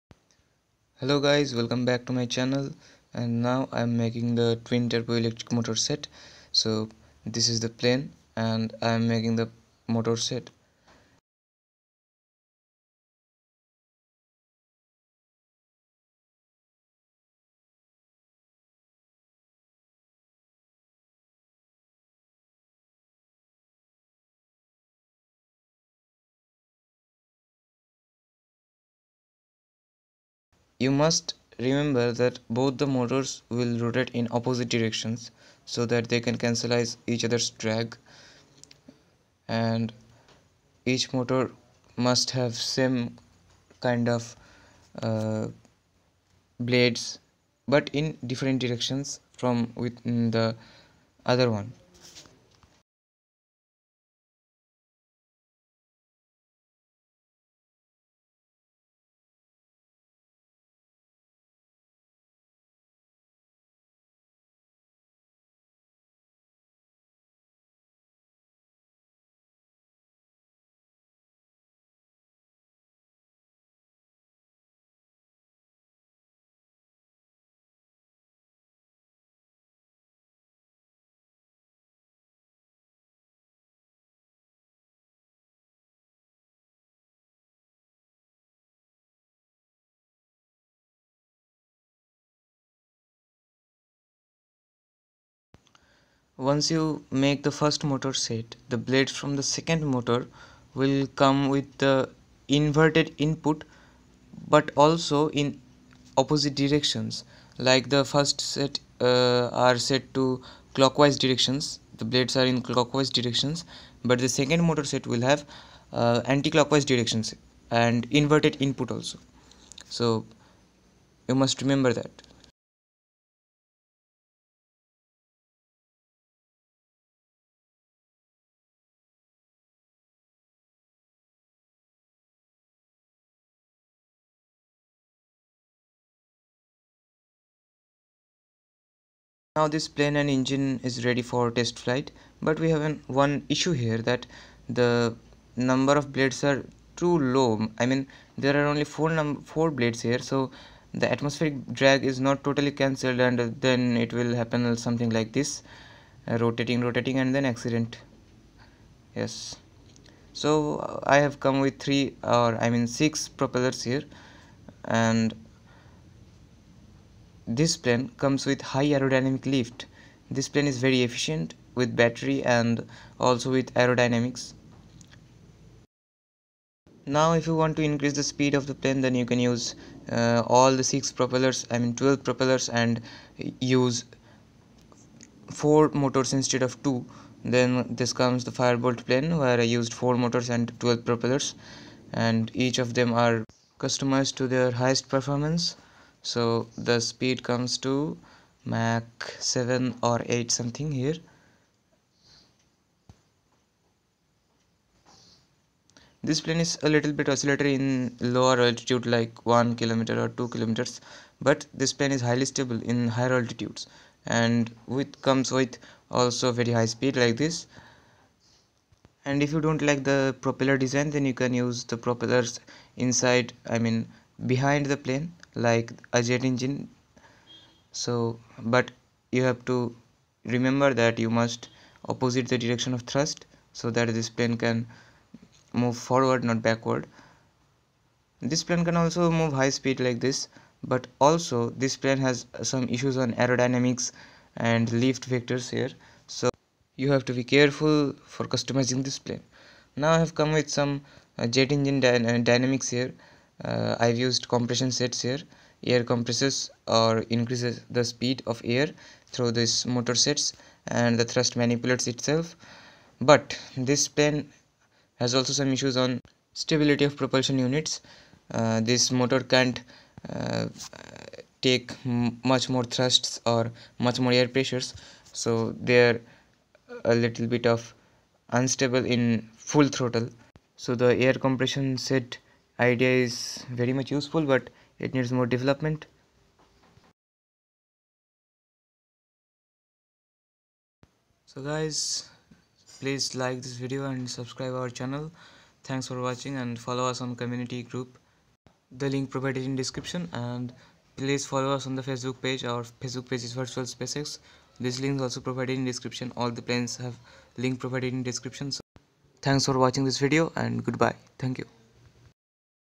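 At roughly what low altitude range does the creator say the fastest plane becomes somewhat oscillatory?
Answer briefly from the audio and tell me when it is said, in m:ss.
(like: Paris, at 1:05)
1 or 2 kilometers, at 3:29.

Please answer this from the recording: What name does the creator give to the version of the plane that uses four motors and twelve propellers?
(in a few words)
firebolt.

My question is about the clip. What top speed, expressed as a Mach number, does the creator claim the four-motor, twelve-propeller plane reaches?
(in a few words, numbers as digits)
Mach 7 or 8.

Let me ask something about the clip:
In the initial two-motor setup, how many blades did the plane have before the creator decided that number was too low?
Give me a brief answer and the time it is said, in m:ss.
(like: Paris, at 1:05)
4, at 2:29.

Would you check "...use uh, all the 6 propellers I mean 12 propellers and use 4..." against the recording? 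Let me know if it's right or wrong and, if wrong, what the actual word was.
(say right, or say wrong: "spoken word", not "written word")
right.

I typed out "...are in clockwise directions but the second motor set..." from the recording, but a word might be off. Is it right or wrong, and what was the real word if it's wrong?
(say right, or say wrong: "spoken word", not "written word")
right.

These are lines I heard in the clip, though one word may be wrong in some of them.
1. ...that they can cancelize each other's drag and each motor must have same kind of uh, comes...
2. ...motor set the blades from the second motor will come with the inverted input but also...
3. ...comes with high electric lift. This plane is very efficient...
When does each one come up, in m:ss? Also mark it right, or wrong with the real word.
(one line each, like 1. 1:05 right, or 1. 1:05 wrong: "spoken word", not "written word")
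1. 0:35 wrong: "blades", not "comes"
2. 1:37 right
3. 2:48 wrong: "aerodynamic", not "electric".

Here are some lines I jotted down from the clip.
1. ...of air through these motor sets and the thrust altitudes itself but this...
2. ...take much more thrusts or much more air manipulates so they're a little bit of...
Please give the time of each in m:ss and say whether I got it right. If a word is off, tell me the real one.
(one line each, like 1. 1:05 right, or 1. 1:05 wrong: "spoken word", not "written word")
1. 4:18 wrong: "manipulates", not "altitudes"
2. 4:31 wrong: "pressures", not "manipulates".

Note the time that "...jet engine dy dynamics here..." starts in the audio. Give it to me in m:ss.
4:11.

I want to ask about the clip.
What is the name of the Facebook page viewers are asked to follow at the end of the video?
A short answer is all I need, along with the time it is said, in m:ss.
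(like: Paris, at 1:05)
Virtual SpaceX, at 5:03.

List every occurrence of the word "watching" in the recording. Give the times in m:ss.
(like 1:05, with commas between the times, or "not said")
4:56, 5:09.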